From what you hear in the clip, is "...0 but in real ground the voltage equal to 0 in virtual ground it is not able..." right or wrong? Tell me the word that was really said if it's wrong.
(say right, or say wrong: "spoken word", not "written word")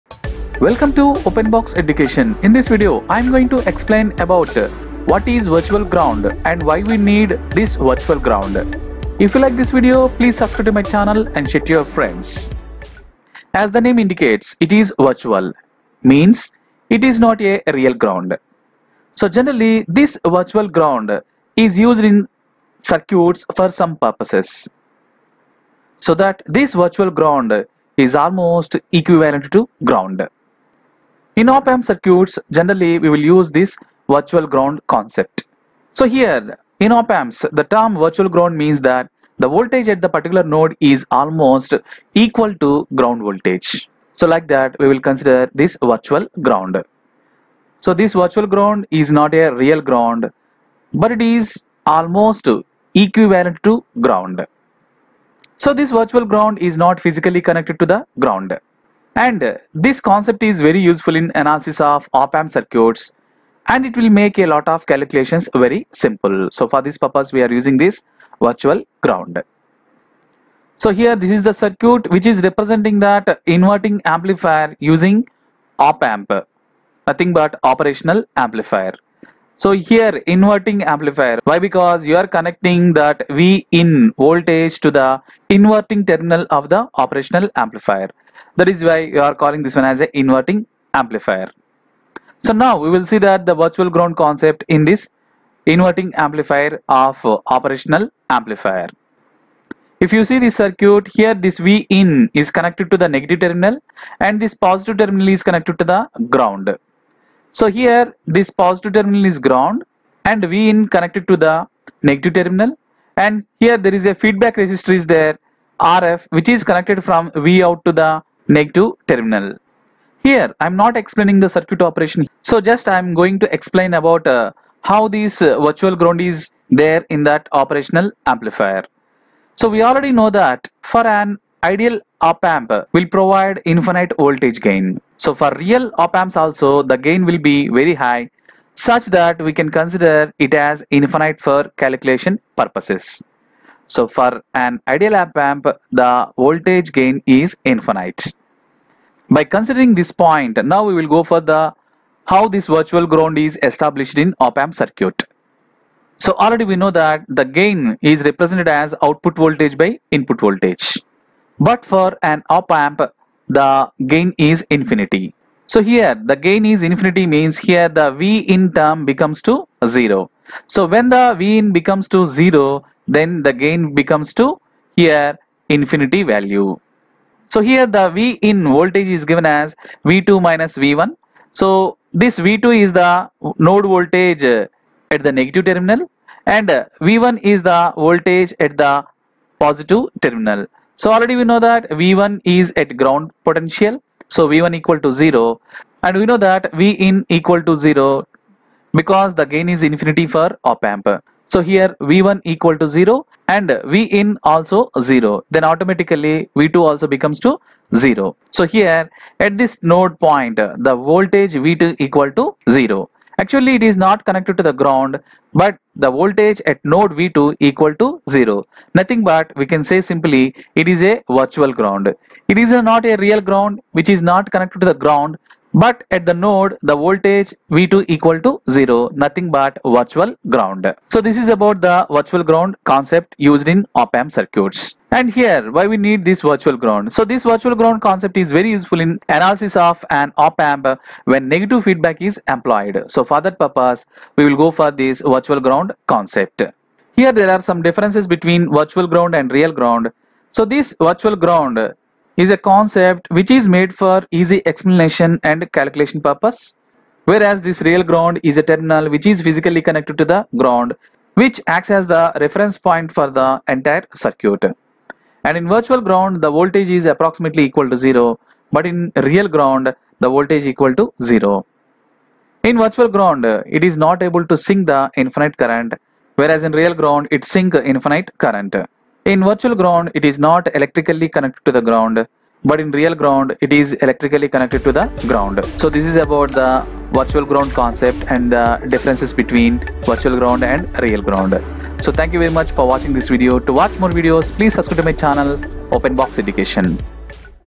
right.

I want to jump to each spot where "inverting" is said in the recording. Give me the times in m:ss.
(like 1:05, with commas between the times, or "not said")
1:13, 1:20, 1:25, 1:30, 1:35.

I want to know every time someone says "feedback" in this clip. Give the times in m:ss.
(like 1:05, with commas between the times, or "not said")
1:54, 4:01.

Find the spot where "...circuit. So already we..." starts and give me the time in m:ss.
2:34.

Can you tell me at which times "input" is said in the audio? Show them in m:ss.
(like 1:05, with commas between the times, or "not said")
2:40.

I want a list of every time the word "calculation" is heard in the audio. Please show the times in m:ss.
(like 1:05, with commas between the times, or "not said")
1:04, 2:21, 4:15.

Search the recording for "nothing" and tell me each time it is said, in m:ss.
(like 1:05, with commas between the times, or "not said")
1:17, 3:38, 3:49.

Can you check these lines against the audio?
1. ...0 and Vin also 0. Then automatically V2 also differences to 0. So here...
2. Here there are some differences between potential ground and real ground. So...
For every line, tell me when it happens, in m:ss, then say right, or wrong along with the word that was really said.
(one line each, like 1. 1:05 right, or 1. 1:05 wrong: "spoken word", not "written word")
1. 3:22 wrong: "becomes", not "differences"
2. 4:07 wrong: "virtual", not "potential".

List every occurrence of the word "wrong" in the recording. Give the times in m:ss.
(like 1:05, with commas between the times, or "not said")
not said.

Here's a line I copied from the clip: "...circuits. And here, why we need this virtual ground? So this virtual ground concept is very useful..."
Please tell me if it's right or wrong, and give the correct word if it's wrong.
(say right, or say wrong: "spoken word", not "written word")
right.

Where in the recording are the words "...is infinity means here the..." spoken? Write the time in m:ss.
2:46.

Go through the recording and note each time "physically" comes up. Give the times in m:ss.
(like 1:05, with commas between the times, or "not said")
0:56, 4:19.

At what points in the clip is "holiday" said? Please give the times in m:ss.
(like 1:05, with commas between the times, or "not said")
not said.